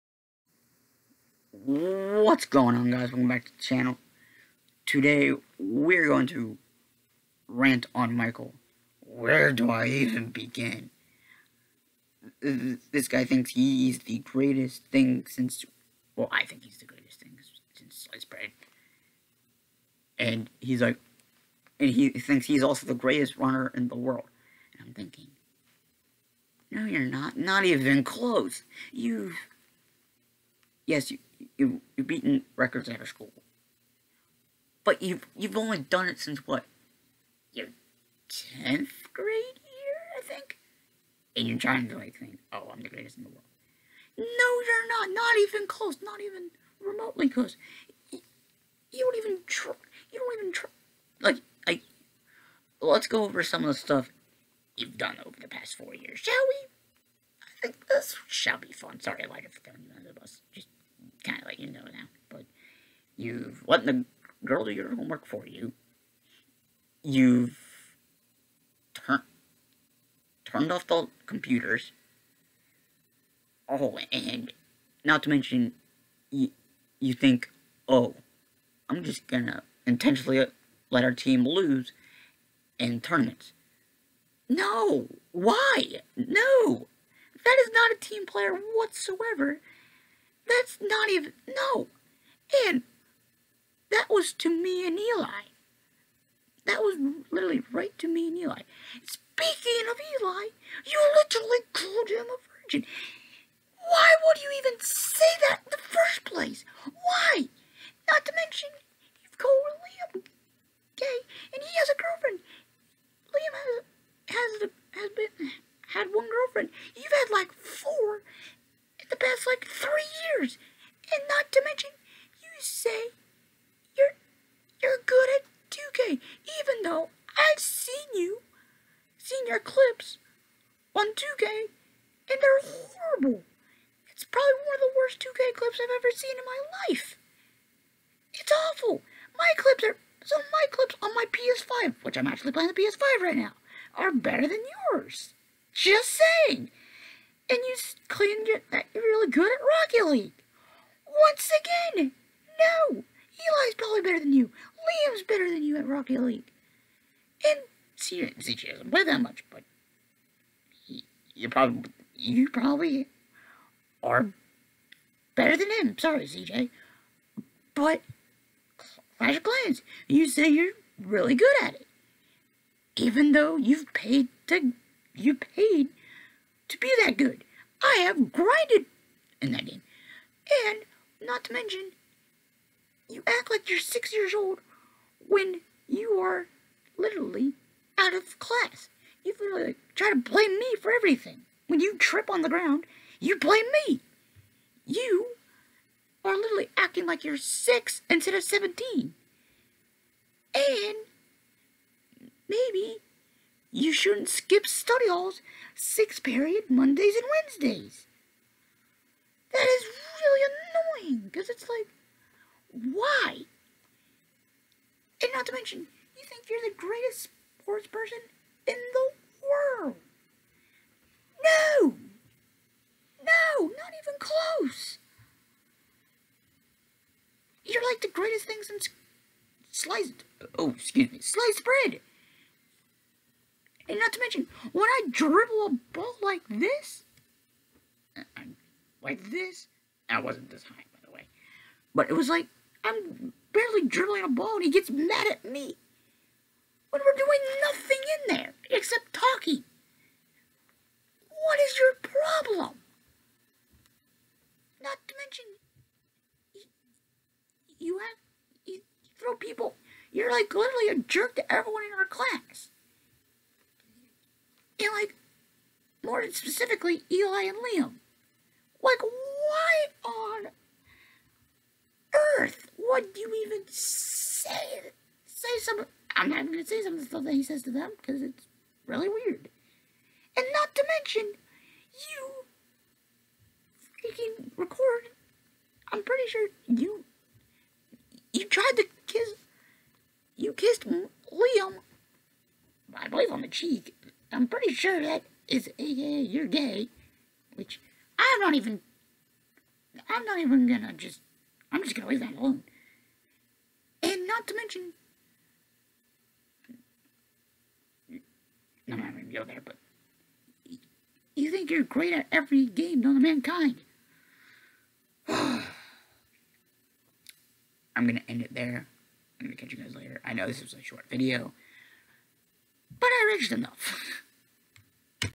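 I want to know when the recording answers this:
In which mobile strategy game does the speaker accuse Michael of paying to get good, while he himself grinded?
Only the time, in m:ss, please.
2:49.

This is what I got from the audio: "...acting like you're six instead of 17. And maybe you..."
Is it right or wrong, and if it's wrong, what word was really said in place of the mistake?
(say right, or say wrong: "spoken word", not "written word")
right.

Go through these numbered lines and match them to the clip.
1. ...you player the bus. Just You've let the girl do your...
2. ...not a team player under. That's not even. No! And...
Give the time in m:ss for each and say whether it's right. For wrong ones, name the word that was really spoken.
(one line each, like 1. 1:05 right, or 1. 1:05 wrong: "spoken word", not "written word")
1. 0:59 wrong: "under", not "player"
2. 1:27 wrong: "whatsoever", not "under".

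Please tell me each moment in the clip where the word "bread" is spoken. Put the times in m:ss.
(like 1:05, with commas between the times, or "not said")
0:18, 3:51.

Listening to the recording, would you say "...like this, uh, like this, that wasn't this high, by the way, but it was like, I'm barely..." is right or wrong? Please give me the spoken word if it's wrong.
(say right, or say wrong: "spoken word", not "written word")
right.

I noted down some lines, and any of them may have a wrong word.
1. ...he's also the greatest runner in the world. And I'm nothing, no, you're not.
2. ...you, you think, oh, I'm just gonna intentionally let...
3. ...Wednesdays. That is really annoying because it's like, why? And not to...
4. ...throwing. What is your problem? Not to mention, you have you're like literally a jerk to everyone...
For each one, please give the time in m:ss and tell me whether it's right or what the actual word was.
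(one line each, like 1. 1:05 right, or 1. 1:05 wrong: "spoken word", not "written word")
1. 0:22 wrong: "thinking", not "nothing"
2. 1:16 right
3. 3:27 right
4. 4:09 wrong: "talking", not "throwing".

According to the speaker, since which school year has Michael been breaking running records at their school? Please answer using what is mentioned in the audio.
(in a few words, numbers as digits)
10th grade.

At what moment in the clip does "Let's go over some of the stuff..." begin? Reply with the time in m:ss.
0:52.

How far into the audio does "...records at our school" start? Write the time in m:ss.
0:32.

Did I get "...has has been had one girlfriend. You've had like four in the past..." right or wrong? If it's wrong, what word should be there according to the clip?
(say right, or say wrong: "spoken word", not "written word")
right.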